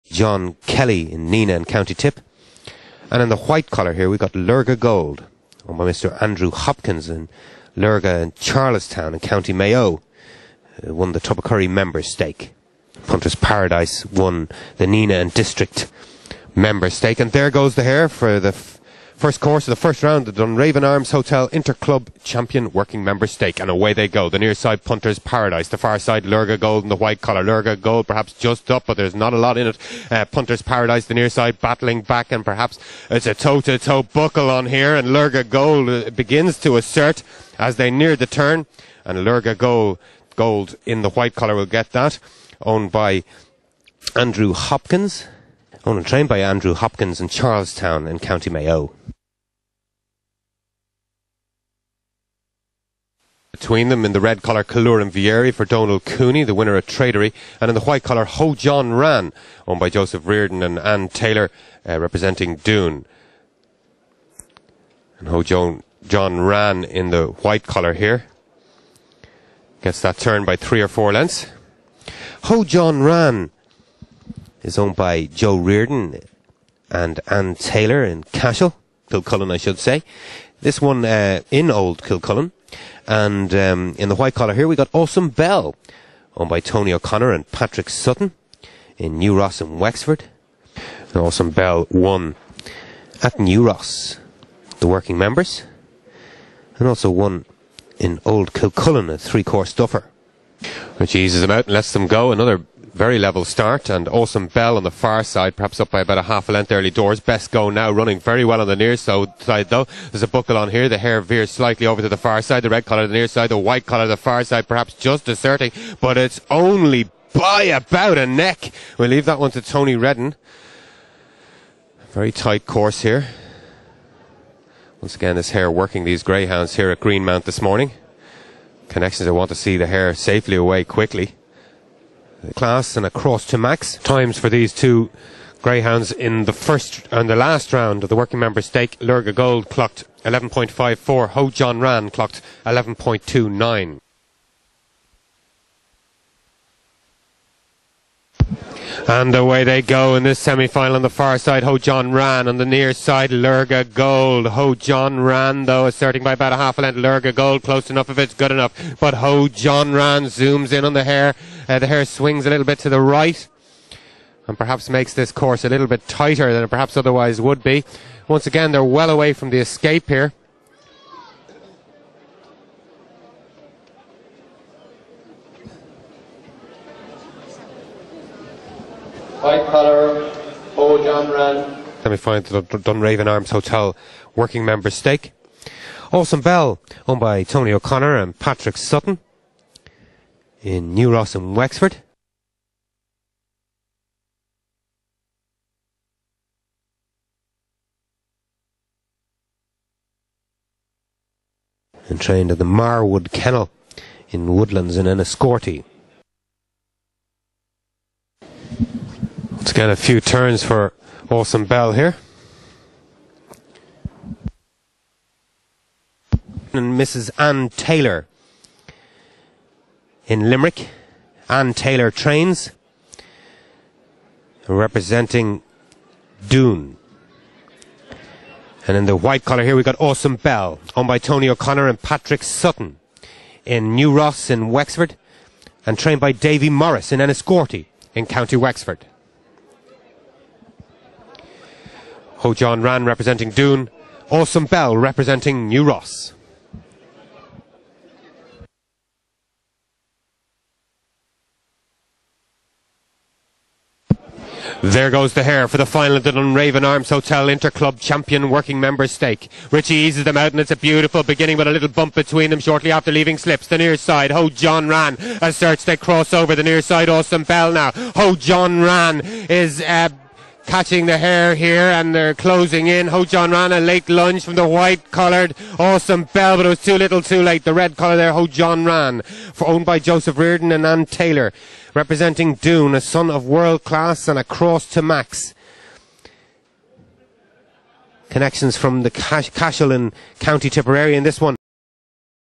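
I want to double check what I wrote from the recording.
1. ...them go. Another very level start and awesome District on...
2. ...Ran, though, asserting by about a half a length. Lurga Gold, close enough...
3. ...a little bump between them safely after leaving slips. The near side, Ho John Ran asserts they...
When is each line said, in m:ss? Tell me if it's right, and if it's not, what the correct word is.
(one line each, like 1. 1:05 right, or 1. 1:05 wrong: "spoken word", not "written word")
1. 1:41 wrong: "Bell", not "District"
2. 2:35 right
3. 4:21 wrong: "shortly", not "safely".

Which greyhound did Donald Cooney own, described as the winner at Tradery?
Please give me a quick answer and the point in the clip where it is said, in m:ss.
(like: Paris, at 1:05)
Caluran Vieri, at 0:54.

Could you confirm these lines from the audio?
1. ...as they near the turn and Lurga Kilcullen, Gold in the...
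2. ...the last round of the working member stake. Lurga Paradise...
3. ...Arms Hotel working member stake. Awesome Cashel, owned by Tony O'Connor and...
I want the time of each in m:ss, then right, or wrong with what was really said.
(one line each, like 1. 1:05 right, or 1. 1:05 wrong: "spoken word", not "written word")
1. 0:37 wrong: "Gold", not "Kilcullen"
2. 2:17 wrong: "Gold", not "Paradise"
3. 3:03 wrong: "Bell", not "Cashel".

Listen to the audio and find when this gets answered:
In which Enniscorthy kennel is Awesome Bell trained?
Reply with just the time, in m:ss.
3:22.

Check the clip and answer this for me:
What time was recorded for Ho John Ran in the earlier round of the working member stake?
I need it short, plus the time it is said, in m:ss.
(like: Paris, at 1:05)
11.29, at 2:22.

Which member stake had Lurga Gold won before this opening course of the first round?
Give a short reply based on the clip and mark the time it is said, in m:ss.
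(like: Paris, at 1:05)
Tubbercurry member stake, at 0:11.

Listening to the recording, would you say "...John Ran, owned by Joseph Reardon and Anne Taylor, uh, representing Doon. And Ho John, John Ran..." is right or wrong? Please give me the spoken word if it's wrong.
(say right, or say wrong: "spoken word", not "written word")
right.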